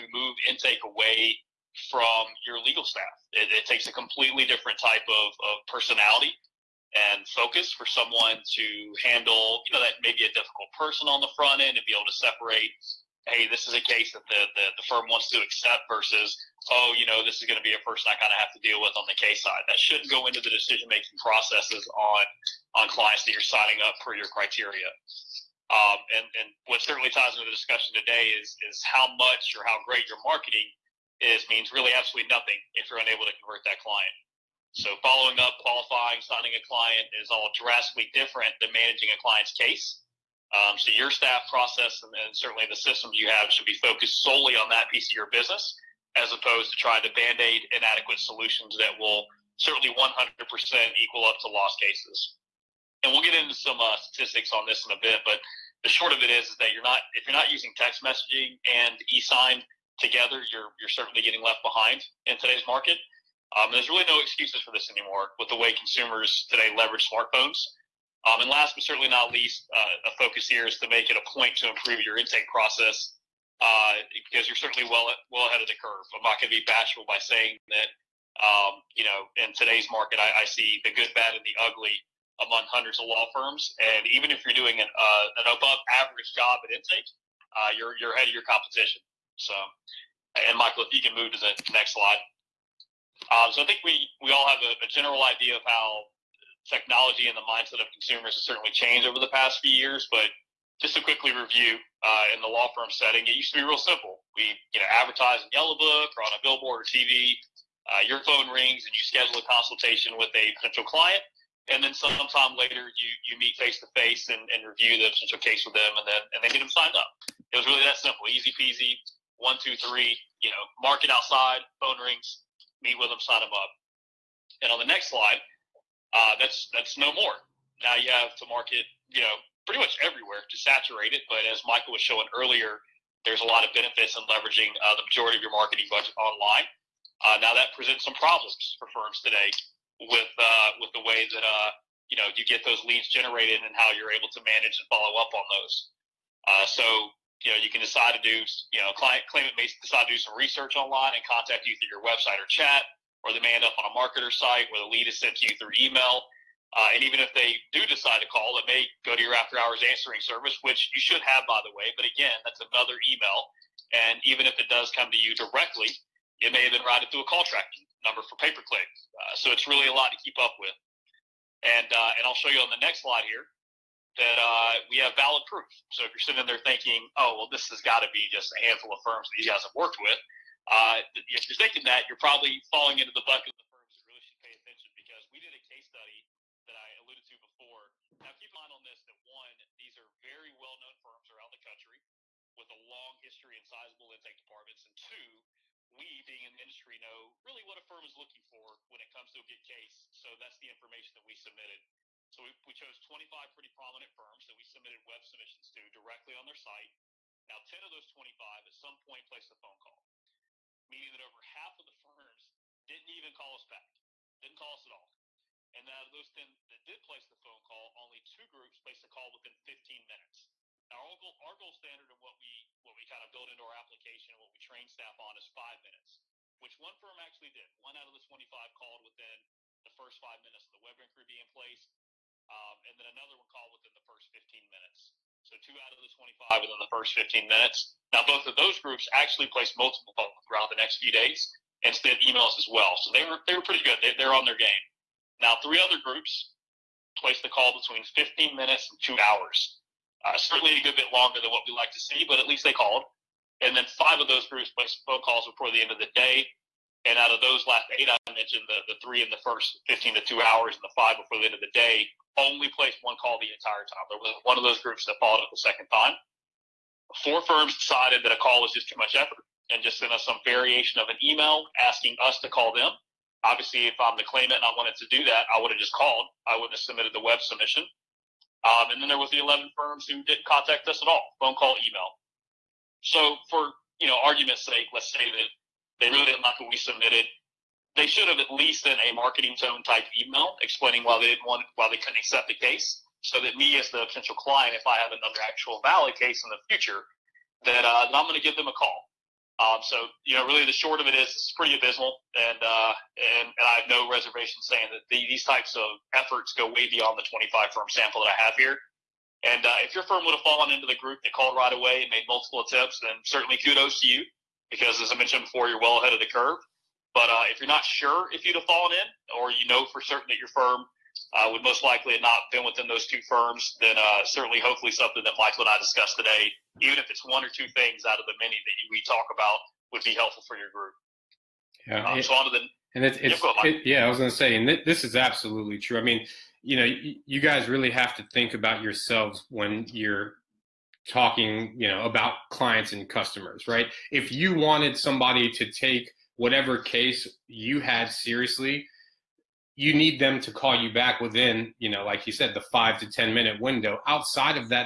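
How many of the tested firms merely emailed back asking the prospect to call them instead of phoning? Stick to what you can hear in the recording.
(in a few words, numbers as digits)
4.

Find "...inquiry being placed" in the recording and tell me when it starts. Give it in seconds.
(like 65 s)
230 s.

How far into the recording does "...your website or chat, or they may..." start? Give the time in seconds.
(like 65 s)
151 s.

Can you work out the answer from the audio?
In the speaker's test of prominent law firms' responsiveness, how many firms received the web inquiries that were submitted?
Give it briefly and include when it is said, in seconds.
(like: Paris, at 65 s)
25, at 203 s.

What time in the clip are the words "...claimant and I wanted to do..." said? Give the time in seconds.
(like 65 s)
274 s.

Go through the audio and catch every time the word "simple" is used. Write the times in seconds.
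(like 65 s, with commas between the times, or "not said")
103 s, 118 s.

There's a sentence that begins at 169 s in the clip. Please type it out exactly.
Uh, so it's really a lot to keep up with.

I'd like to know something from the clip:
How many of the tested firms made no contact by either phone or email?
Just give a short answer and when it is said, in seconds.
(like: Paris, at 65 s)
11, at 279 s.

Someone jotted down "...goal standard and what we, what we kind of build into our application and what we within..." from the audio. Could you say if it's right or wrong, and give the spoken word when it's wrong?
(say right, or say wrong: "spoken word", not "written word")
wrong: "train", not "within".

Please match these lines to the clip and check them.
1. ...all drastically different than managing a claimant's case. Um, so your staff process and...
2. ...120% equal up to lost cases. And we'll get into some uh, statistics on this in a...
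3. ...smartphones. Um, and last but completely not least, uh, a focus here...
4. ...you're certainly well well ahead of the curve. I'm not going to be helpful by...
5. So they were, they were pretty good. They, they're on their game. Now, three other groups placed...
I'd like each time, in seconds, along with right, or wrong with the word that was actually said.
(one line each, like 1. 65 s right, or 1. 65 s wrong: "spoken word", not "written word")
1. 37 s wrong: "client", not "claimant"
2. 49 s wrong: "100", not "120"
3. 67 s wrong: "certainly", not "completely"
4. 74 s wrong: "bashful", not "helpful"
5. 243 s right.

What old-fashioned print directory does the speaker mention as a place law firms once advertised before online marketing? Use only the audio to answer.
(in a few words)
Yellow Book.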